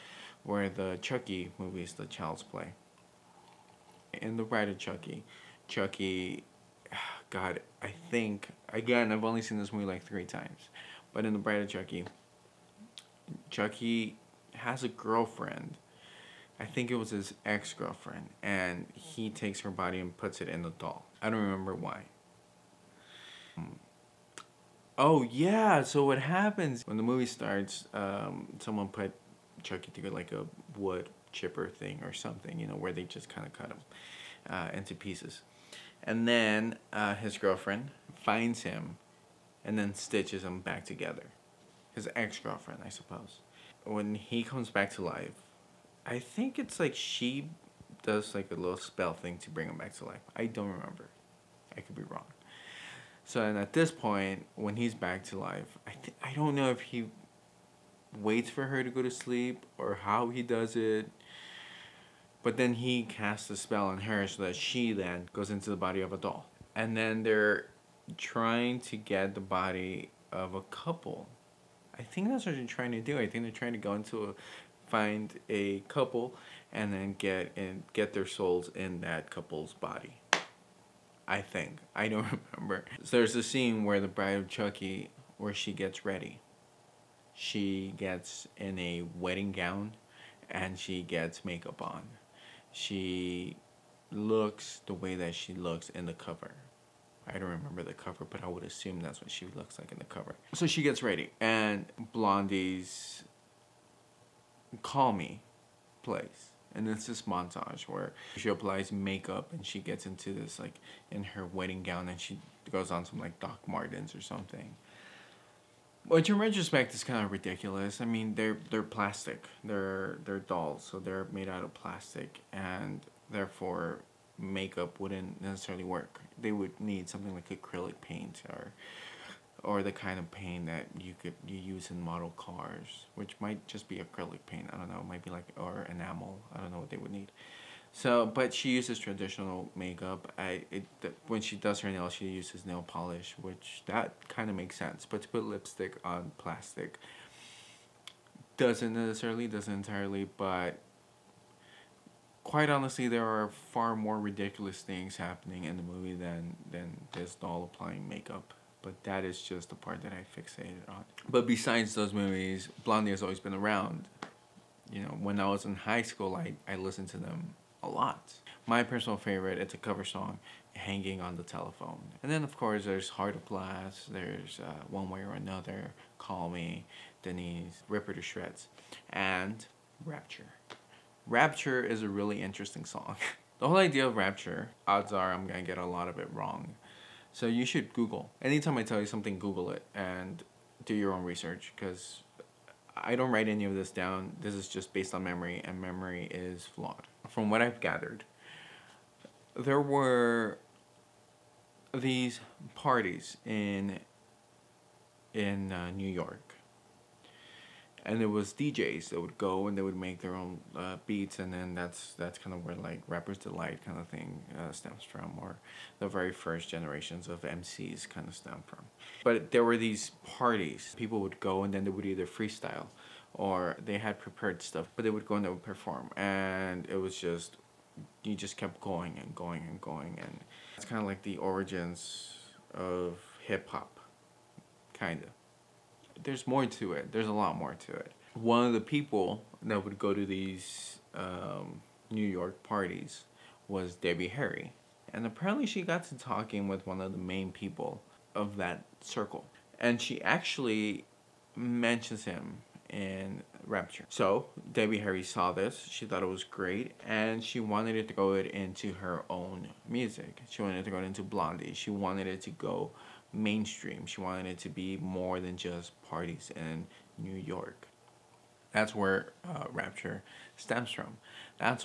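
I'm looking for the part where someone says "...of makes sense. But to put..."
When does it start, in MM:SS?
02:24.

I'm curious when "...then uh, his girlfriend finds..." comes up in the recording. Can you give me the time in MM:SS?
00:36.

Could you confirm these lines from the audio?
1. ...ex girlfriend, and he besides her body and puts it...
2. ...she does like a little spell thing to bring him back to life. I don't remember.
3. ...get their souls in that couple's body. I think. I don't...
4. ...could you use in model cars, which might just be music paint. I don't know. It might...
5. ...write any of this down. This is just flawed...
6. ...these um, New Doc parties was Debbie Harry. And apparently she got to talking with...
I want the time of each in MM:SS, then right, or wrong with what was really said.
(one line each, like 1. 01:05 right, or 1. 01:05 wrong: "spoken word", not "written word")
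1. 00:17 wrong: "takes", not "besides"
2. 00:46 right
3. 01:17 right
4. 02:11 wrong: "acrylic", not "music"
5. 03:13 wrong: "based", not "flawed"
6. 04:00 wrong: "York", not "Doc".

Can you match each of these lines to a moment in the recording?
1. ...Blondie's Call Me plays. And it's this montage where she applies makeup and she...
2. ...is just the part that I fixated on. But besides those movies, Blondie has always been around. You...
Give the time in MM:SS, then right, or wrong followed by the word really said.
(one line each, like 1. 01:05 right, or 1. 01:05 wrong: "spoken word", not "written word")
1. 01:42 right
2. 02:39 right.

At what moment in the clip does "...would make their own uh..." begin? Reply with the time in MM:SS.
03:29.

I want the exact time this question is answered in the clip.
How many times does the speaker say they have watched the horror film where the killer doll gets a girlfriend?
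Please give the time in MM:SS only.
00:10.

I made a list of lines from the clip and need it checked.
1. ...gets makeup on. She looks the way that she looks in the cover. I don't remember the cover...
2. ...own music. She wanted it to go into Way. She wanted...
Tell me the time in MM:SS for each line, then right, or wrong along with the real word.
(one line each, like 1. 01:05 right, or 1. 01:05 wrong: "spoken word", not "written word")
1. 01:31 right
2. 04:19 wrong: "Blondie", not "Way".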